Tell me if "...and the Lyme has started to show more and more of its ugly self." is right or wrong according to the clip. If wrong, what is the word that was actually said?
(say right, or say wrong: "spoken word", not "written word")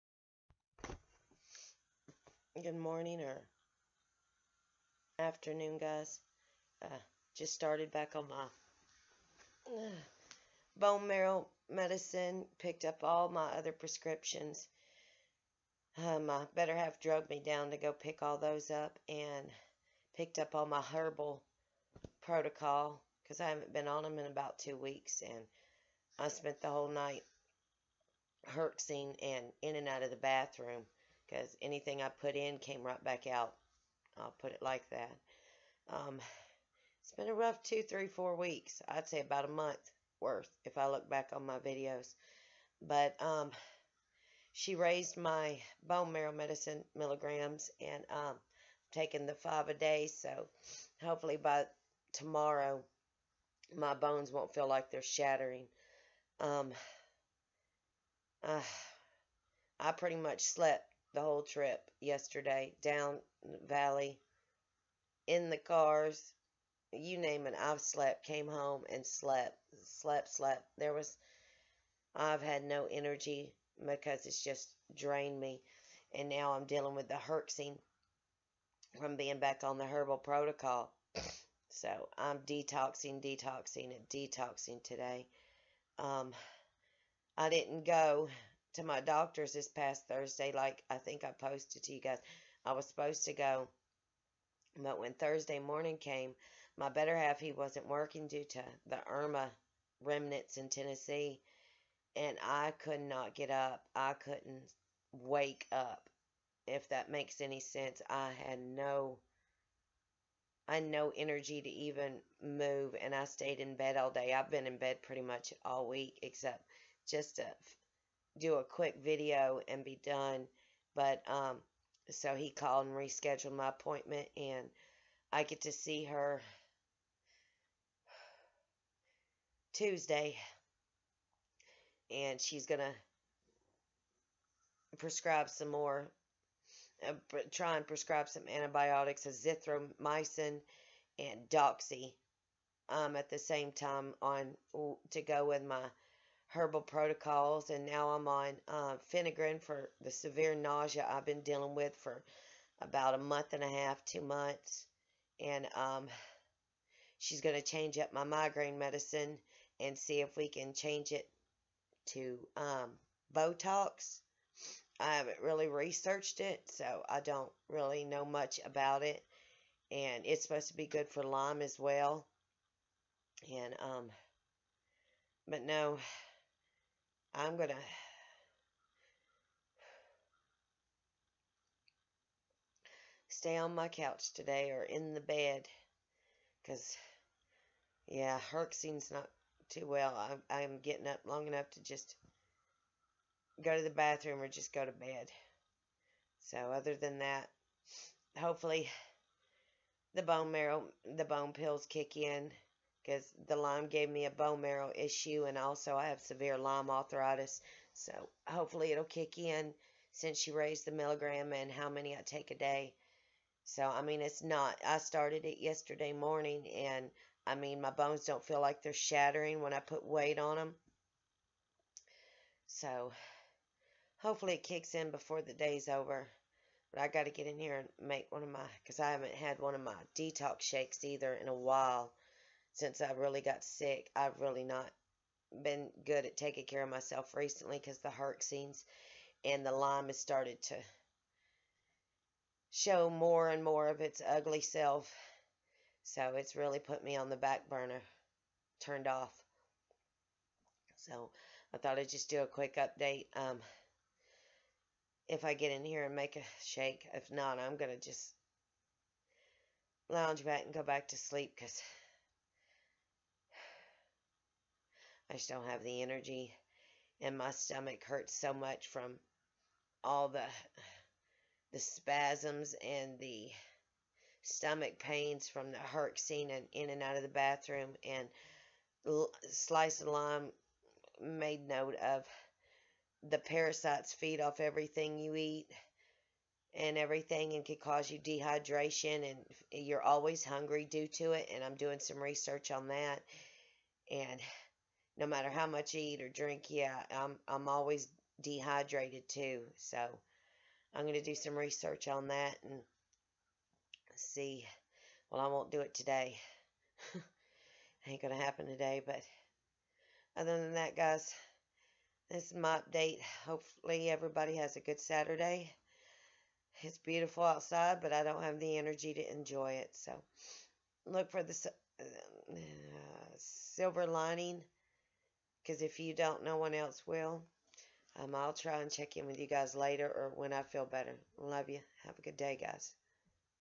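right.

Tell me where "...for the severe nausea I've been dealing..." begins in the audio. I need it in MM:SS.
02:29.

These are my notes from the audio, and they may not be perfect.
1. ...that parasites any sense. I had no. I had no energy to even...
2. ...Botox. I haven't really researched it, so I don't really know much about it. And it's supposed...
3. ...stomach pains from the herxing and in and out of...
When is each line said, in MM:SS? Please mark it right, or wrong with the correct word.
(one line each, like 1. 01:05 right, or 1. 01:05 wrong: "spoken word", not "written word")
1. 01:46 wrong: "makes", not "parasites"
2. 02:43 right
3. 04:34 right.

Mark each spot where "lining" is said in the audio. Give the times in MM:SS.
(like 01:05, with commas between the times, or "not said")
05:24.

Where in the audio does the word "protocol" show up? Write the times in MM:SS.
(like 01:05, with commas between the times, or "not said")
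00:22, 01:20, 02:26.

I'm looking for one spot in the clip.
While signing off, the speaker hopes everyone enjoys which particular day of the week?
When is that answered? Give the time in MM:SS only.
05:14.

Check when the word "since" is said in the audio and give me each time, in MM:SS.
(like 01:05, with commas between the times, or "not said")
03:30, 03:52.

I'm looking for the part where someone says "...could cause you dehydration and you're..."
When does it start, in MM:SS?
04:47.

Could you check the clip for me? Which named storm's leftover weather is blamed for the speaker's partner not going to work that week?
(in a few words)
Irma.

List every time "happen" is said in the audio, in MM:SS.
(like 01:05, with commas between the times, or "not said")
05:08.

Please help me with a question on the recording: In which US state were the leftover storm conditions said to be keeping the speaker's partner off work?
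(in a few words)
Tennessee.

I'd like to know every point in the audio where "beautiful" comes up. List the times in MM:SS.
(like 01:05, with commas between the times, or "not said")
05:16.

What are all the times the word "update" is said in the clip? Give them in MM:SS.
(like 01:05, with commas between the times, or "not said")
04:12, 05:12.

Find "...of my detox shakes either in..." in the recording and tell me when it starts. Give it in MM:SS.
03:49.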